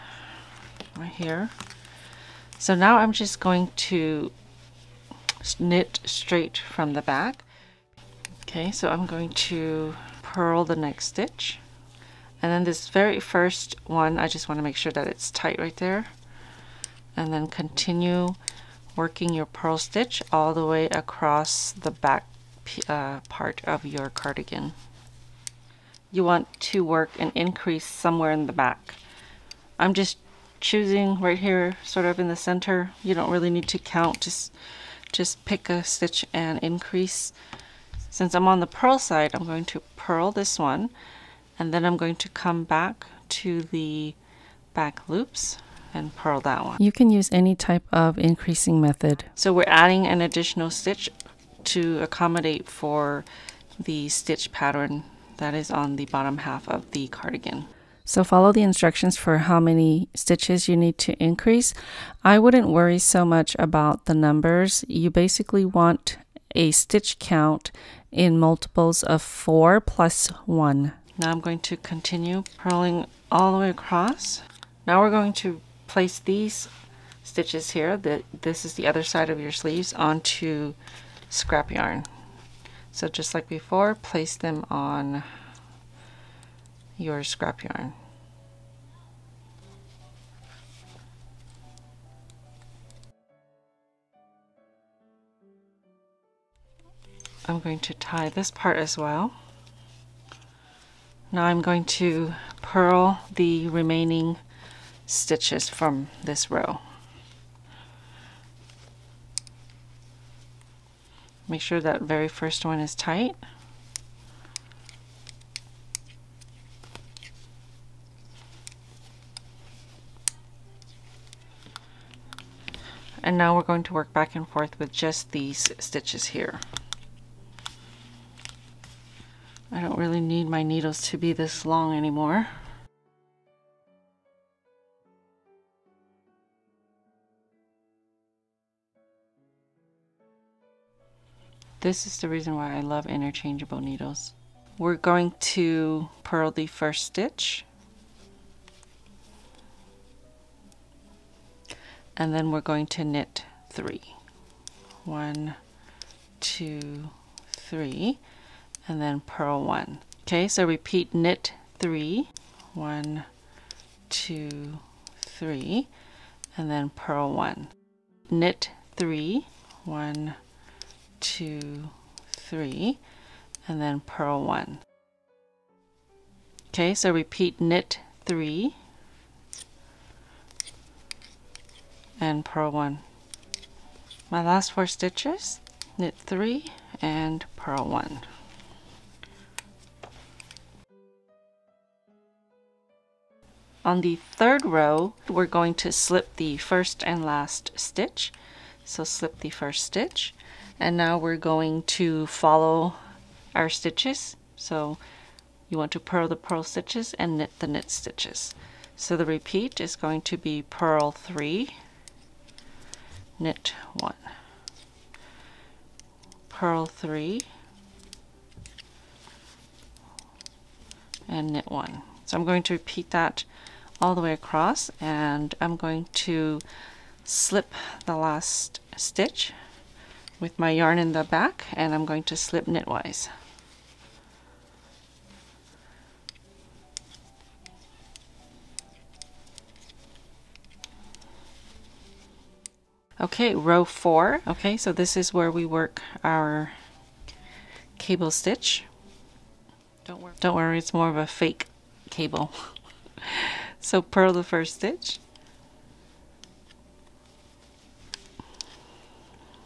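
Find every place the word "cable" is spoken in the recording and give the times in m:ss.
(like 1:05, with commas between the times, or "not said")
4:07, 4:12.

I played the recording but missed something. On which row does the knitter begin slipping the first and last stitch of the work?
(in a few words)
Third row.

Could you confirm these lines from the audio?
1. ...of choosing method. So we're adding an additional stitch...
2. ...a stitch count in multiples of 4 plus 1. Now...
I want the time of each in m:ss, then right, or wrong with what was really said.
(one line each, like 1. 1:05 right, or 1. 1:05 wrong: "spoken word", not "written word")
1. 0:47 wrong: "increasing", not "choosing"
2. 1:06 right.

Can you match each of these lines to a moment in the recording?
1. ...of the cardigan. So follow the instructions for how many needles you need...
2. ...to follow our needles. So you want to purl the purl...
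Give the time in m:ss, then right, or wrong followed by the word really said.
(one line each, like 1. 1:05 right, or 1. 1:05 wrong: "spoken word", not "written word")
1. 0:56 wrong: "stitches", not "needles"
2. 3:21 wrong: "stitches", not "needles".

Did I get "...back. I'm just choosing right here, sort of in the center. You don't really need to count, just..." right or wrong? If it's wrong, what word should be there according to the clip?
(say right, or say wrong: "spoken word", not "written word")
right.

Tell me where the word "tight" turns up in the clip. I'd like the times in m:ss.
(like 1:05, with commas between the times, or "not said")
0:15, 1:52.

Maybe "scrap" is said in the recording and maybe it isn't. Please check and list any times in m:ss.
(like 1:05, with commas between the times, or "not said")
1:21, 1:27.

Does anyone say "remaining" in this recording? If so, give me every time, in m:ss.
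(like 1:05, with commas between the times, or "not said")
1:43.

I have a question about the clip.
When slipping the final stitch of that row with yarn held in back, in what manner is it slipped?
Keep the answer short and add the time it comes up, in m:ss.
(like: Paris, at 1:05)
Knitwise, at 3:52.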